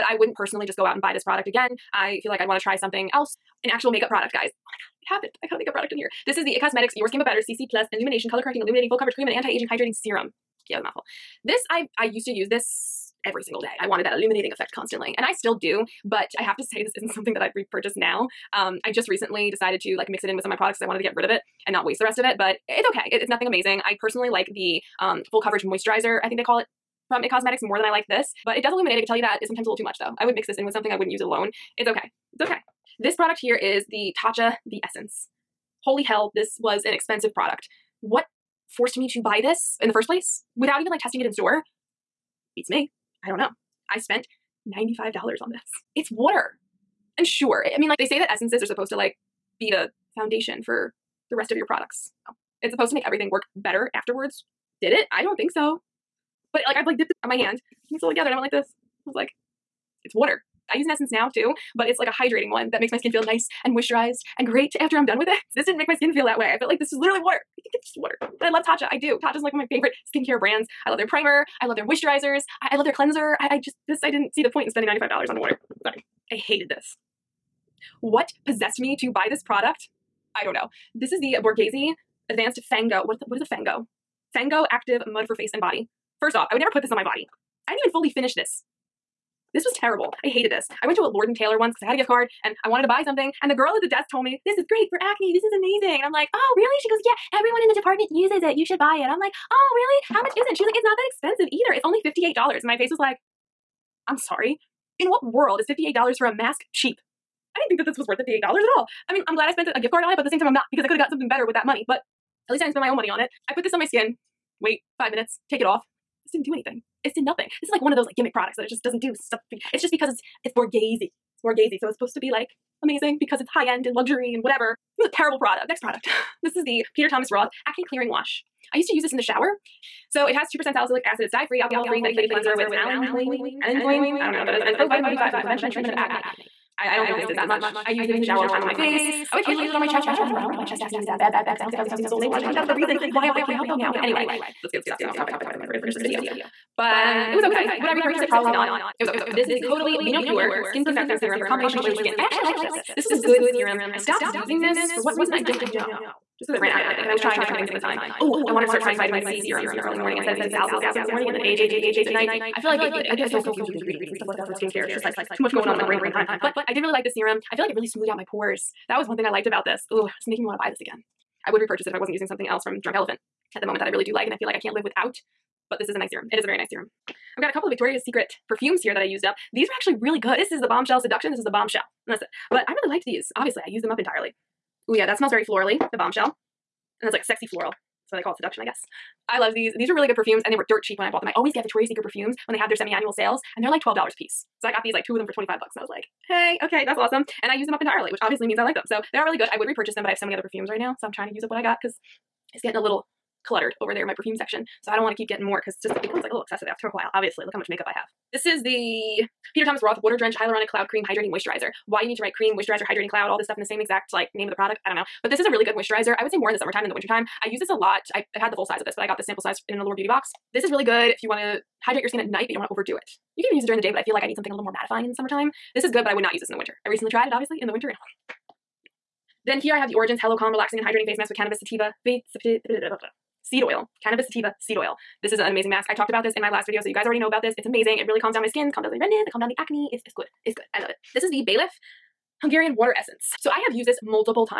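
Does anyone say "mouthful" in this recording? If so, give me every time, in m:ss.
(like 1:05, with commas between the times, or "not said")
0:10.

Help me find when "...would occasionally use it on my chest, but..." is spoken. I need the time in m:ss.
2:19.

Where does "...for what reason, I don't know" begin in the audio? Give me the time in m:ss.
2:34.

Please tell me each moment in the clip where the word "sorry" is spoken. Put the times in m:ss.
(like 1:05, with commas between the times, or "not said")
1:15, 1:44.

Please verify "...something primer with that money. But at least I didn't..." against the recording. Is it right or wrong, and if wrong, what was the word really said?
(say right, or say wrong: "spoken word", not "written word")
wrong: "better", not "primer".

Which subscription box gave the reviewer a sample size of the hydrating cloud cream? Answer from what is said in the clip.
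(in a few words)
Allure Beauty box.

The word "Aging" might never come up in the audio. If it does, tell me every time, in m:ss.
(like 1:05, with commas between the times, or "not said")
0:09.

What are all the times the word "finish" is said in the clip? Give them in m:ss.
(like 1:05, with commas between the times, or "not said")
1:28, 2:25.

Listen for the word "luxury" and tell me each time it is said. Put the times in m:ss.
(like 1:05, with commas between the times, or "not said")
2:03.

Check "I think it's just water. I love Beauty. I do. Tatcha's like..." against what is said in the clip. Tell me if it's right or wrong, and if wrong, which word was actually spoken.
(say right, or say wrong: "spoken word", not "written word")
wrong: "Tatcha", not "Beauty".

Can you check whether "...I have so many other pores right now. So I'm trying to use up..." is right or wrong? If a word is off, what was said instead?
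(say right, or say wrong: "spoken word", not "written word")
wrong: "perfumes", not "pores".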